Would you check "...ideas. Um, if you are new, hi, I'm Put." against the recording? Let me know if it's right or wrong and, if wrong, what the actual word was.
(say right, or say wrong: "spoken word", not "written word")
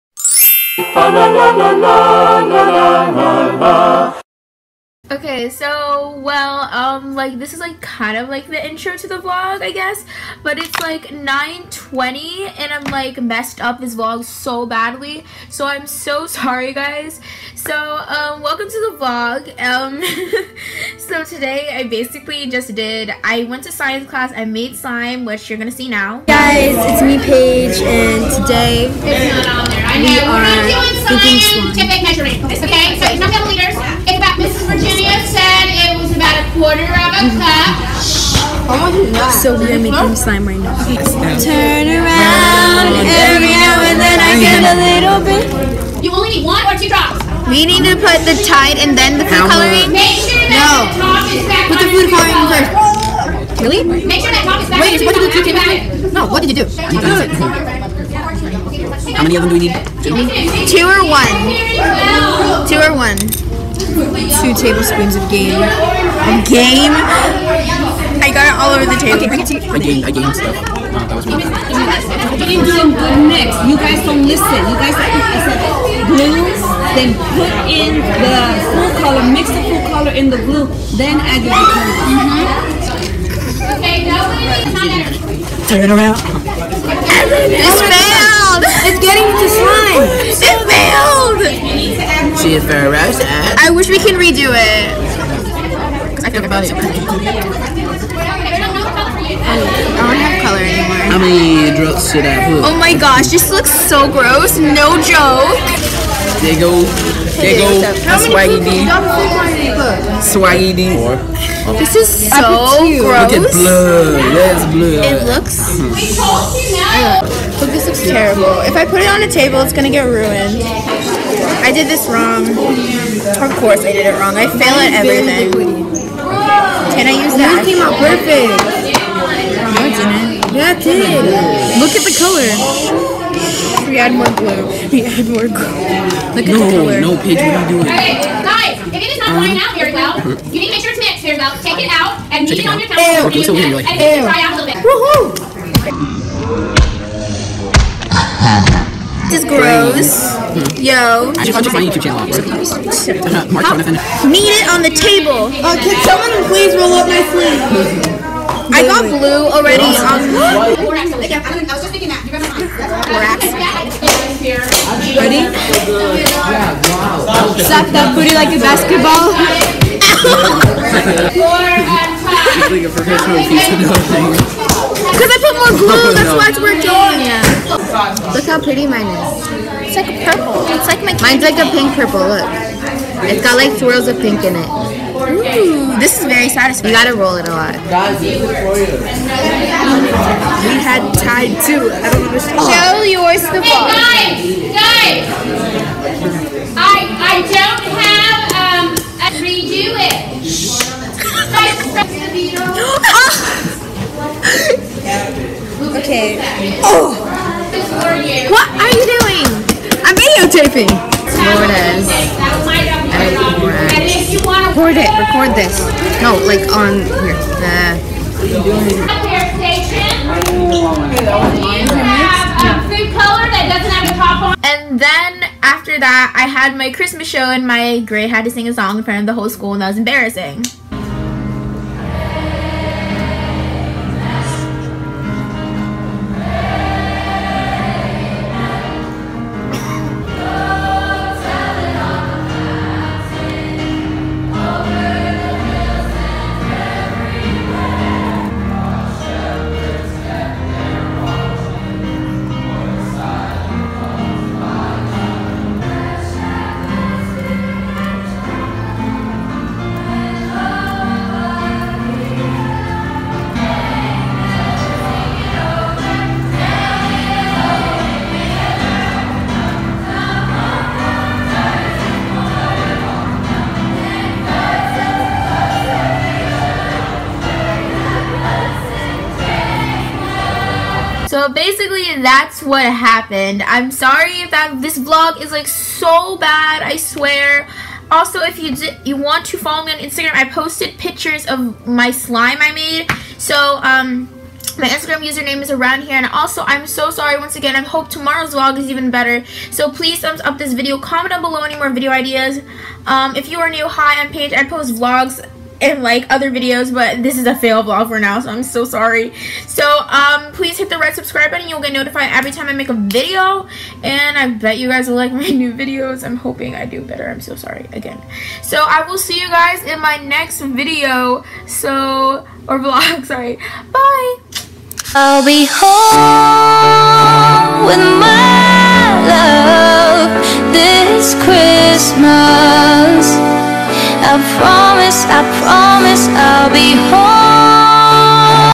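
wrong: "Paige", not "Put".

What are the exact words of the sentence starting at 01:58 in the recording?
If I put it on a table, it's gonna get ruined.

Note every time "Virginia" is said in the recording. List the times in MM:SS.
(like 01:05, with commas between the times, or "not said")
00:34.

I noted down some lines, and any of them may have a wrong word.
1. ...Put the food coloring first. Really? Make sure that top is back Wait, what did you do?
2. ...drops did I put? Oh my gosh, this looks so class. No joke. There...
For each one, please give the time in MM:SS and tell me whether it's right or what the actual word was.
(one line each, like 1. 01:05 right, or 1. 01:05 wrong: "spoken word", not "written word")
1. 00:51 right
2. 01:41 wrong: "gross", not "class".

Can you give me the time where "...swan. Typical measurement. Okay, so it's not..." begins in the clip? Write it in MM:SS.
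00:31.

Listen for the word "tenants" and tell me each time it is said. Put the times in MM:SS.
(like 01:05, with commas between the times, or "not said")
not said.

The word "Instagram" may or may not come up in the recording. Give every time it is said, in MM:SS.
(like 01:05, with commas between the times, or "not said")
04:49, 04:54.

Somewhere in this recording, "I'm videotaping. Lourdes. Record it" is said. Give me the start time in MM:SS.
03:30.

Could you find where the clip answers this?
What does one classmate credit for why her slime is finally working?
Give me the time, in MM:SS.
02:55.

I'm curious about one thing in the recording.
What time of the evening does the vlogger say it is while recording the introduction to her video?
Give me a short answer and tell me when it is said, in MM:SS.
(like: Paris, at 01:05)
9:20, at 00:11.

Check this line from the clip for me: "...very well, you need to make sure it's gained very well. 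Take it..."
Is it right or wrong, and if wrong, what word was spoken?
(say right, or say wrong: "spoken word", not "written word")
wrong: "mixed", not "gained".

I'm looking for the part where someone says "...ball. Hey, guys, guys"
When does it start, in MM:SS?
03:13.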